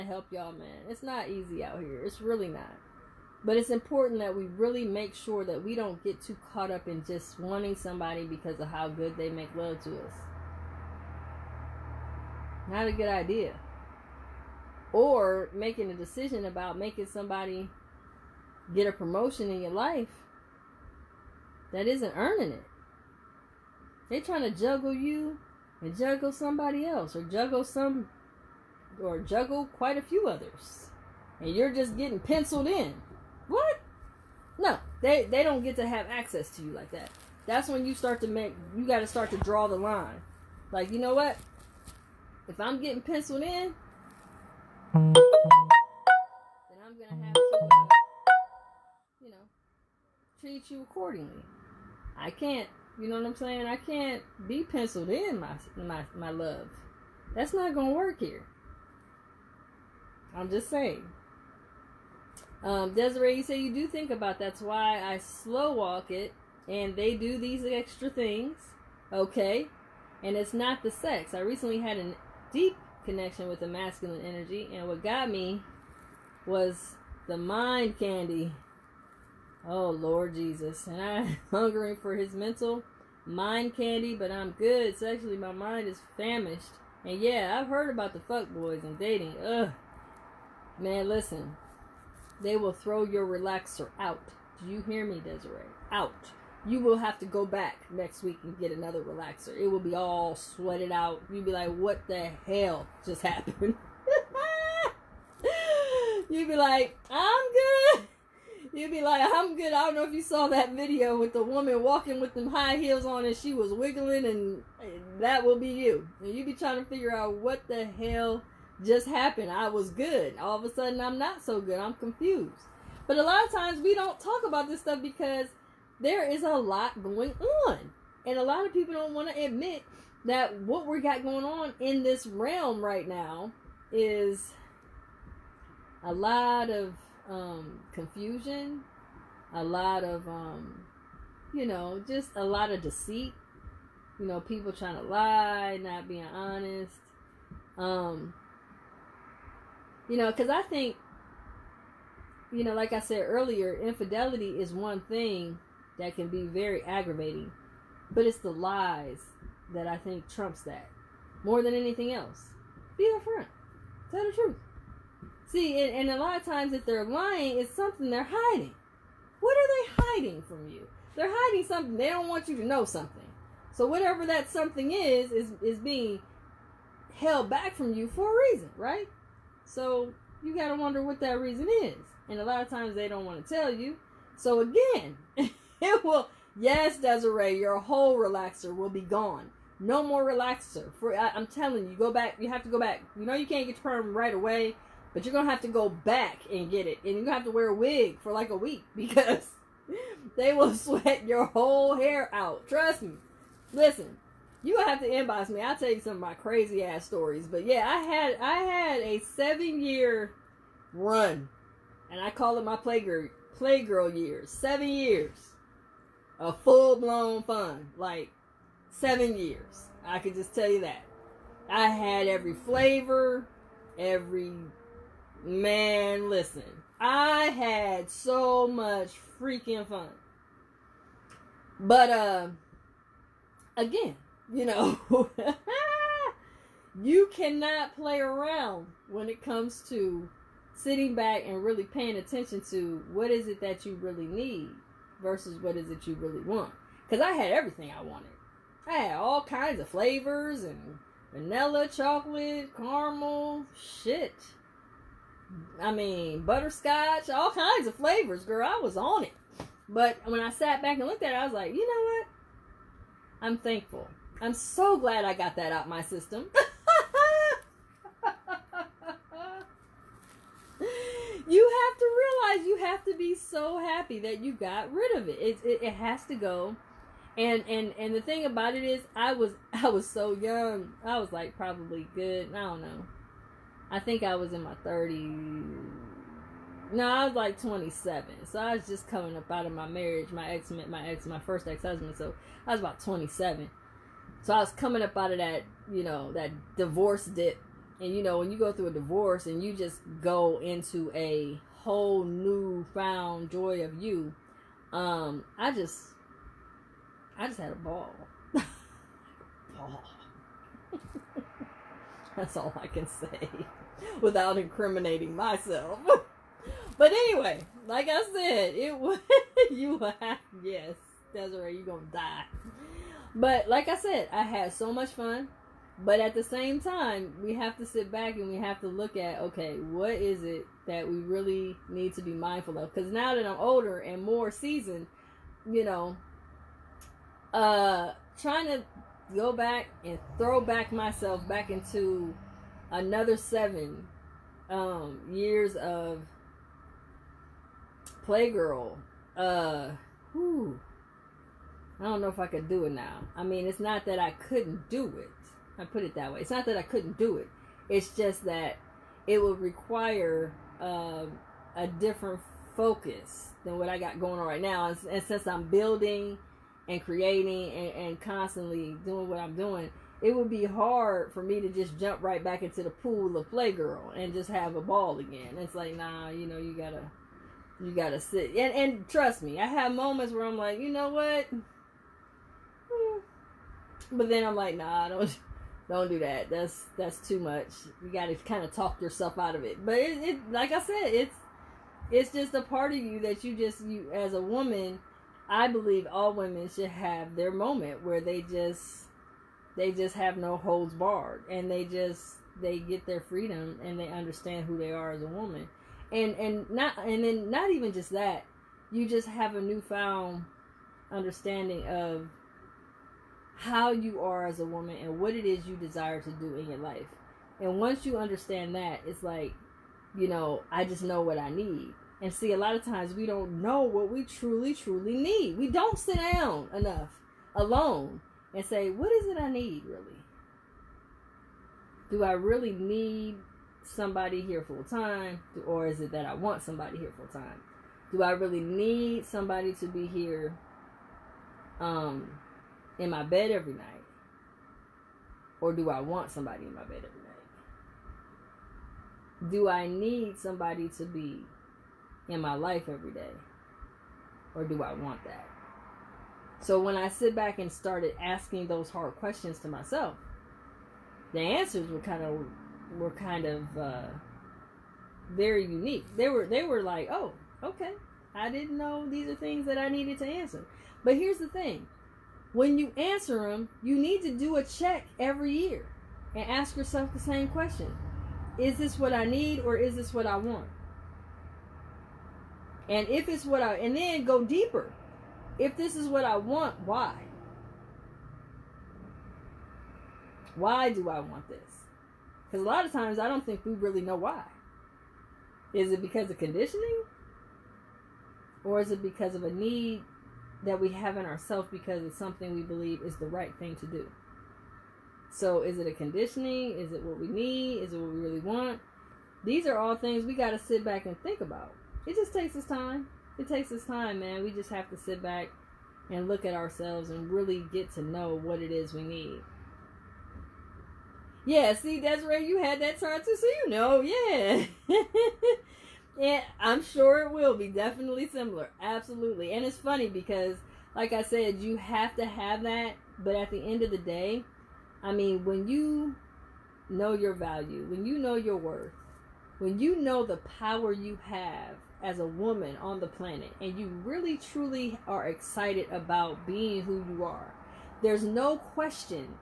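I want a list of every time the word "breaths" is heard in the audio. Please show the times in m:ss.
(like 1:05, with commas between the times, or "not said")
not said.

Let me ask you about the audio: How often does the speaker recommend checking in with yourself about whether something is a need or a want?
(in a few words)
every year.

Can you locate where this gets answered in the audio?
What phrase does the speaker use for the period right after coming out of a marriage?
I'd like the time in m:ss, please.
4:56.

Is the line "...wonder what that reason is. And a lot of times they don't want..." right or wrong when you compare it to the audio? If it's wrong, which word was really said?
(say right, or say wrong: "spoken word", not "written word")
right.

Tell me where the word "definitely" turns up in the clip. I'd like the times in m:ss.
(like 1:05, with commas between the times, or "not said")
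8:47.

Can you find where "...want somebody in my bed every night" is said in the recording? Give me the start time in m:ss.
7:26.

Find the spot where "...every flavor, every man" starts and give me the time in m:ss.
3:42.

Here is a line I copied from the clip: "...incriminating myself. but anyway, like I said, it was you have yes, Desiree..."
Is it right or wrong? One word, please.
right.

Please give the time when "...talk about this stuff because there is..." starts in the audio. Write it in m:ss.
2:04.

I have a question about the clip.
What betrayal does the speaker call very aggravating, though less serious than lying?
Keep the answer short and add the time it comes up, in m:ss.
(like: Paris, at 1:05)
infidelity, at 2:33.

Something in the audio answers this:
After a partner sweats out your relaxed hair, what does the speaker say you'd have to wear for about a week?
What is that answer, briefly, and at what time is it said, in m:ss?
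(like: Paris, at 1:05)
a wig, at 3:17.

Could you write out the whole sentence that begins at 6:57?
And once you understand that, it's like, you know, I just know what I need.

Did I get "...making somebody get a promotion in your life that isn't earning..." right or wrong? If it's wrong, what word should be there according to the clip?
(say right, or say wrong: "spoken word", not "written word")
right.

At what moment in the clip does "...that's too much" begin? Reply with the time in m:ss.
6:26.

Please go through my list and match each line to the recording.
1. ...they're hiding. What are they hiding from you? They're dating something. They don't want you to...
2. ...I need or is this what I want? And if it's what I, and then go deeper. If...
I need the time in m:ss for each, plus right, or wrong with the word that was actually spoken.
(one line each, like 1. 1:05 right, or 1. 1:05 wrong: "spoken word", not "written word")
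1. 2:48 wrong: "hiding", not "dating"
2. 7:59 right.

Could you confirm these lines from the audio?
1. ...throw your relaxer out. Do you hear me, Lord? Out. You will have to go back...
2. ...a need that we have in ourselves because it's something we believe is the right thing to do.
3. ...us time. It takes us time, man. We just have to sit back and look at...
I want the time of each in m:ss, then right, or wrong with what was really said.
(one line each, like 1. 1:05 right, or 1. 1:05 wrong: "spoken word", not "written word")
1. 1:32 wrong: "Desiree", not "Lord"
2. 8:19 right
3. 8:32 right.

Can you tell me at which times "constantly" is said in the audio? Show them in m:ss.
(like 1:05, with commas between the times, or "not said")
6:08.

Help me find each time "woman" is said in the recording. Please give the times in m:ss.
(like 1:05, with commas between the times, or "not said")
1:51, 6:34, 6:45, 6:54, 9:02.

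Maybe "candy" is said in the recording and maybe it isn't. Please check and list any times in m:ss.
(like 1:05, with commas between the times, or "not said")
1:17, 1:23.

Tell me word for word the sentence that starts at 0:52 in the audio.
I can't, you know what I'm saying?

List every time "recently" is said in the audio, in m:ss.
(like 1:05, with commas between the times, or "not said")
1:11.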